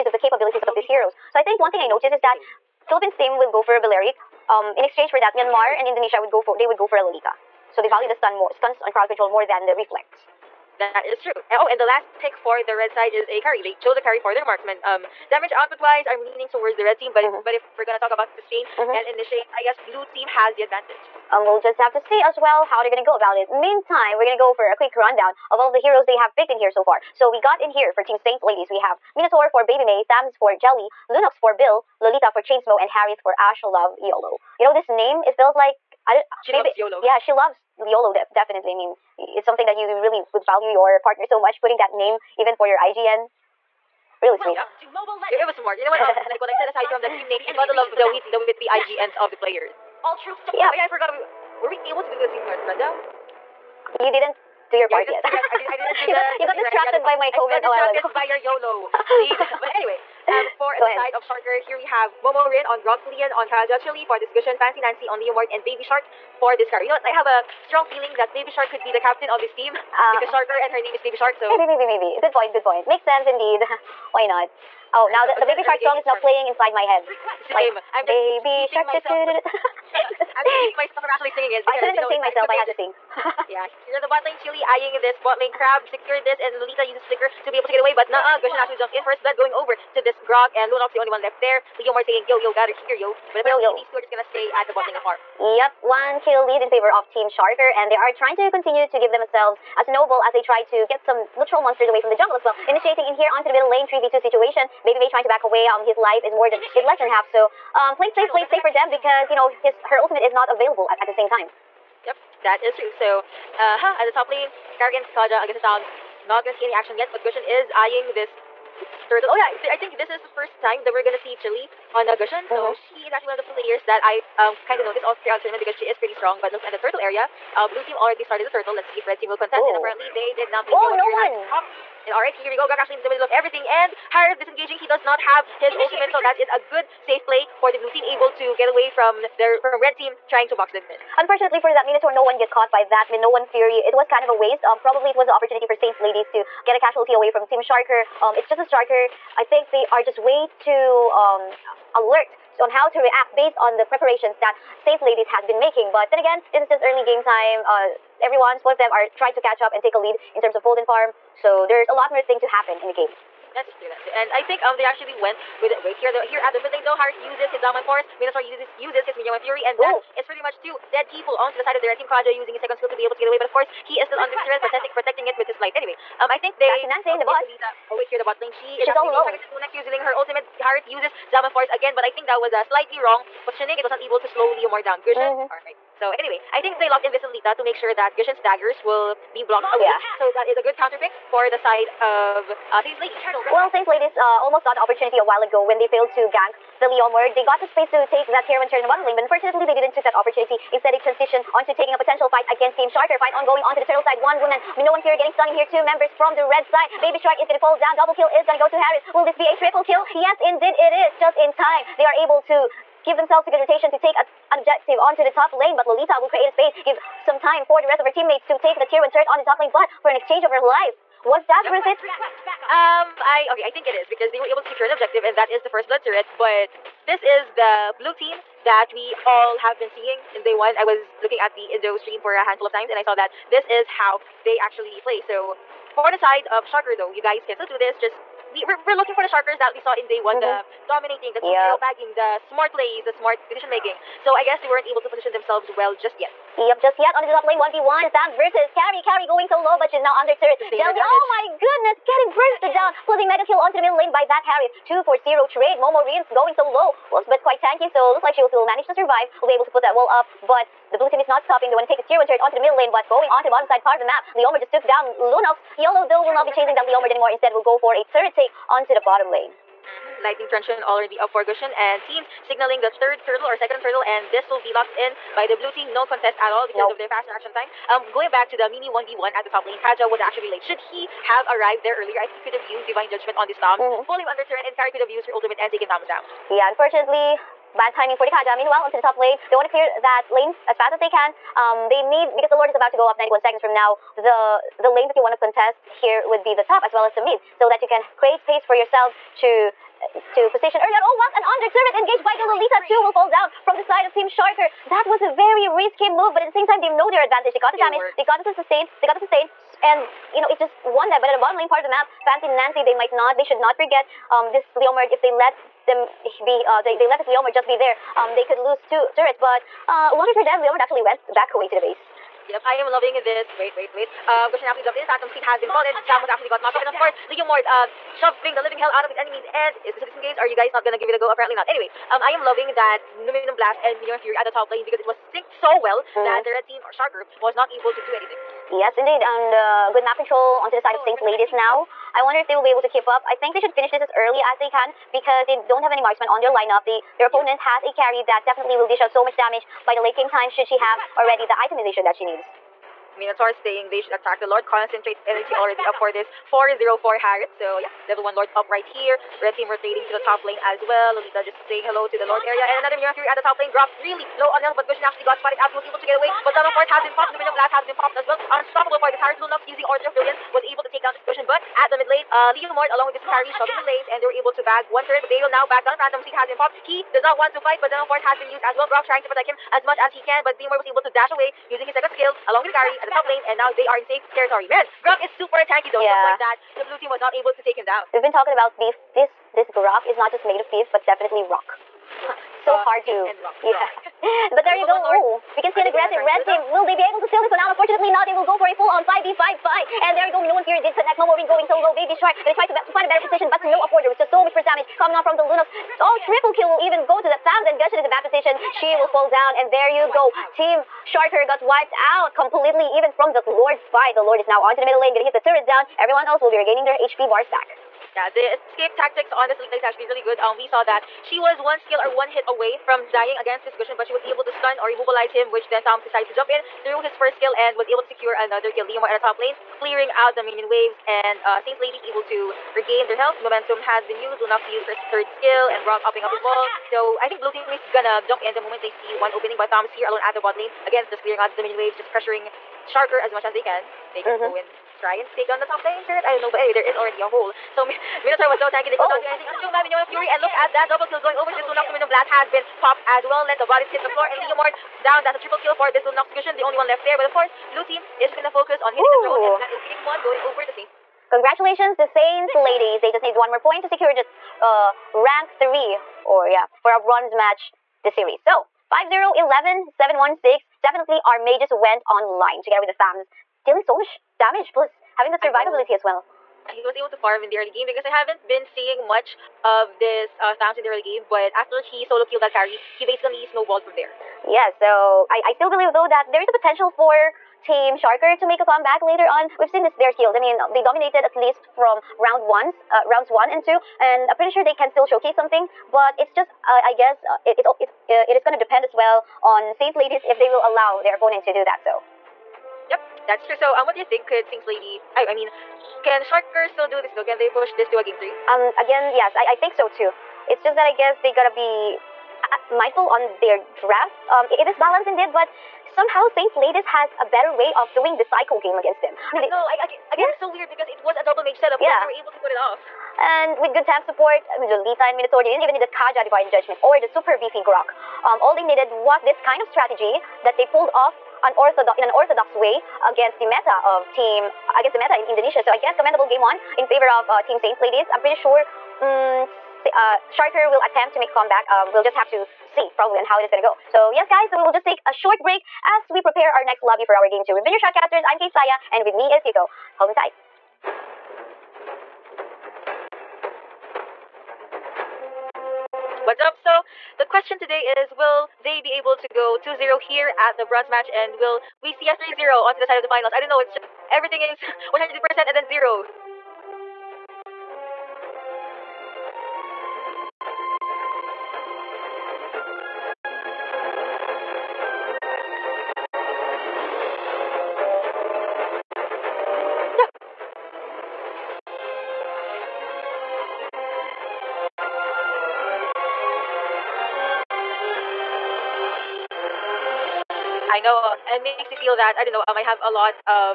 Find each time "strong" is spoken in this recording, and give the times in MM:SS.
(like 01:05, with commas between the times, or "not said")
01:07, 02:06.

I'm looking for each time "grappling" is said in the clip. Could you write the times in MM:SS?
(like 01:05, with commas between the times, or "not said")
not said.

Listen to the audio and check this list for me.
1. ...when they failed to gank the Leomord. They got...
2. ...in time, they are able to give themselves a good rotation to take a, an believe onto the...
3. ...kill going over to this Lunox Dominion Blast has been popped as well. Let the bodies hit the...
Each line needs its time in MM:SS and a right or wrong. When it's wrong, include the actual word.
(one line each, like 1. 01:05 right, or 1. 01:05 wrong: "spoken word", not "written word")
1. 03:15 right
2. 03:31 wrong: "objective", not "believe"
3. 07:31 right.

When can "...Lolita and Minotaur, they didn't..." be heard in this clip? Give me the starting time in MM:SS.
08:44.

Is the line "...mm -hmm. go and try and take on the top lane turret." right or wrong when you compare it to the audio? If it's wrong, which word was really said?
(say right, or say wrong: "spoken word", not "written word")
right.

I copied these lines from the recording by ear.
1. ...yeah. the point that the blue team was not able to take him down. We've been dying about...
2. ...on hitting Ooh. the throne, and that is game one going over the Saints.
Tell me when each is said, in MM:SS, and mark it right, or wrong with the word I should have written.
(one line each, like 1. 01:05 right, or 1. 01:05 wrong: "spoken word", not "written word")
1. 06:26 wrong: "talking", not "dying"
2. 07:38 right.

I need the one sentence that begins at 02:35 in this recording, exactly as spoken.
But then again, this is just early game time.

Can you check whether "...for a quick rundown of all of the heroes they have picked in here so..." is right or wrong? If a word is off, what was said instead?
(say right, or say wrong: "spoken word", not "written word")
right.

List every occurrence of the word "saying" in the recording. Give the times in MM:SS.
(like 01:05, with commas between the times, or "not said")
01:32, 05:53, 06:01.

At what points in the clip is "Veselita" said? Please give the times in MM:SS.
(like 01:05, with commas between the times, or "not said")
03:07.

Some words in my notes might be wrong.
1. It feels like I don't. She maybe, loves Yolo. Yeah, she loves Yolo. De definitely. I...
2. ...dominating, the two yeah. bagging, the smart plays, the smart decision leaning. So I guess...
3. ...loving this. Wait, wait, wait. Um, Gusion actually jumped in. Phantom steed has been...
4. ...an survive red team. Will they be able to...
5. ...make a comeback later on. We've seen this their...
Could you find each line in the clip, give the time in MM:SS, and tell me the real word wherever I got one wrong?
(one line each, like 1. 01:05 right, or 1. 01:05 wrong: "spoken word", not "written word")
1. 00:35 right
2. 04:00 wrong: "making", not "leaning"
3. 05:22 right
4. 06:35 wrong: "aggressive", not "survive"
5. 08:08 right.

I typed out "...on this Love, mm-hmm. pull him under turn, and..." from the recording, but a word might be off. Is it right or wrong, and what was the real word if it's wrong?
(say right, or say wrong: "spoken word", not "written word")
wrong: "Toms", not "Love".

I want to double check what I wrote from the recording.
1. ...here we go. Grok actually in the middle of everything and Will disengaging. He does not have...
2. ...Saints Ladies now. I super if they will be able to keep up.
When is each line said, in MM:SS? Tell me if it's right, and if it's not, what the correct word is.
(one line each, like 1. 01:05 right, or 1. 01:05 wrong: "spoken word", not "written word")
1. 02:12 wrong: "Hard", not "Will"
2. 05:41 wrong: "wonder", not "super".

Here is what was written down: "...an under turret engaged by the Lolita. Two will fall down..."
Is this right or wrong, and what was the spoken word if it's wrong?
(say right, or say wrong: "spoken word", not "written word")
right.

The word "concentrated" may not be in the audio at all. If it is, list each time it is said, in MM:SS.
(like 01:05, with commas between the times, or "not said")
05:54.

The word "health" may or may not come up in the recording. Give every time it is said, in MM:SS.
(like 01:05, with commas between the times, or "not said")
06:04, 07:13.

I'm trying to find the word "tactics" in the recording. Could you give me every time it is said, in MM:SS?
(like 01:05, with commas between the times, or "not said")
06:58.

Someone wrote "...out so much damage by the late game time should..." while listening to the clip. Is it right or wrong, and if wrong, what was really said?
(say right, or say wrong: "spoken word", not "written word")
right.